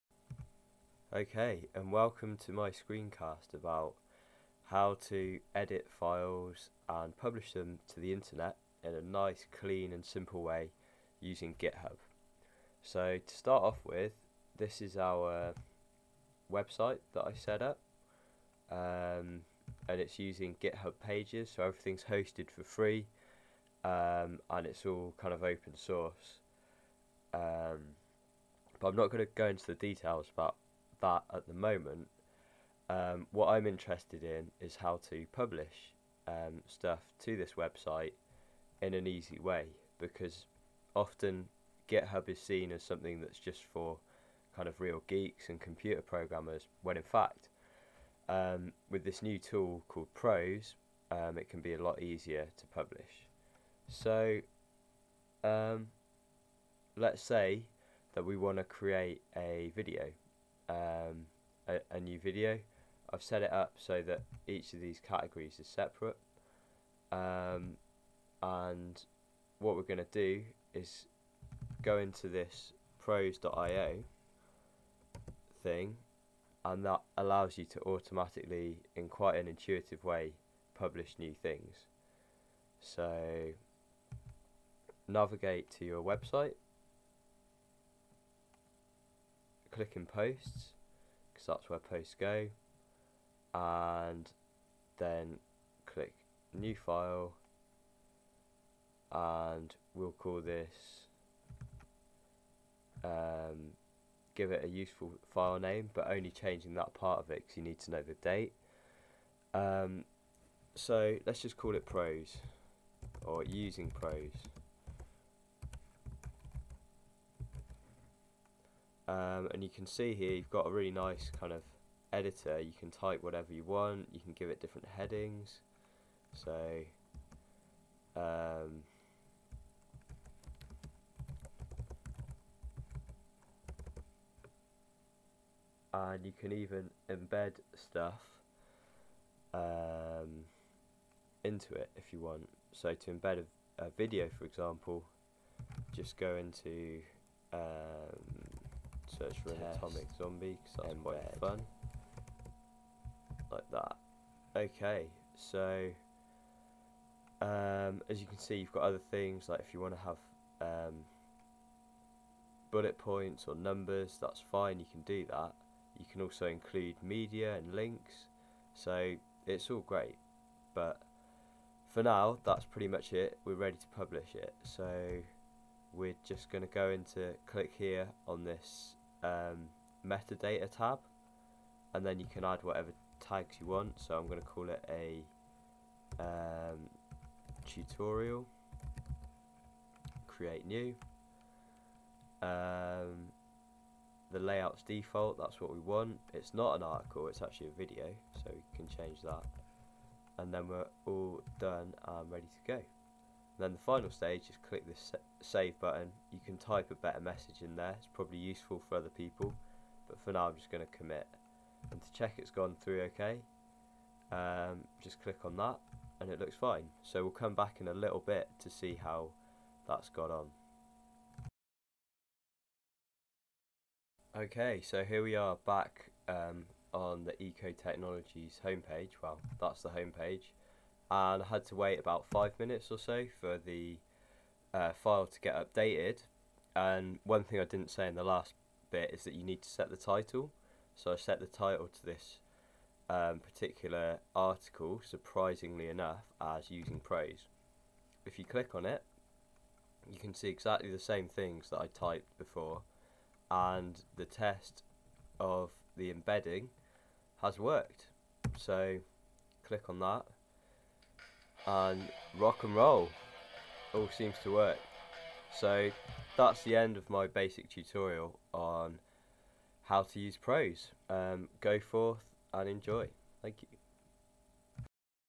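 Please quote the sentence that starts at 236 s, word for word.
And one thing I didn't say in the last bit is that you need to set the title.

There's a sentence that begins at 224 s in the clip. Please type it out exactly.
Okay, so here we are back um, on the Eco Technologies homepage.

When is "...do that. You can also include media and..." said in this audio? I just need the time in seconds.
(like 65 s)
165 s.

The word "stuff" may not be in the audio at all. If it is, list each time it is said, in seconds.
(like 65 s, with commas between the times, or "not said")
36 s, 137 s.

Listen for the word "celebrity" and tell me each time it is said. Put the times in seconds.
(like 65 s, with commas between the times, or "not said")
not said.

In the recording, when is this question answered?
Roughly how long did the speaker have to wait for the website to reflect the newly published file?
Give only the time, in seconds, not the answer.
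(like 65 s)
231 s.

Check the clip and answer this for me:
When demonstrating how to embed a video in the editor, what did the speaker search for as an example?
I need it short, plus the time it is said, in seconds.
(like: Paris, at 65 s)
atomic zombie, at 149 s.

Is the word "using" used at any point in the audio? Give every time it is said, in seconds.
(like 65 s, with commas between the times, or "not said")
11 s, 20 s, 113 s, 246 s.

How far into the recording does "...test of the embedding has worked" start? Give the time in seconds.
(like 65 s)
254 s.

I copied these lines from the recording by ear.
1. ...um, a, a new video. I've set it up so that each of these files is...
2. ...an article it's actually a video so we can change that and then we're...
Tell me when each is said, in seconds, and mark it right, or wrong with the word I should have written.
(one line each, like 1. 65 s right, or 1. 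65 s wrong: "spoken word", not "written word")
1. 60 s wrong: "categories", not "files"
2. 196 s right.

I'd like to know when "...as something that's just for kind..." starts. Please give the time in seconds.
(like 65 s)
42 s.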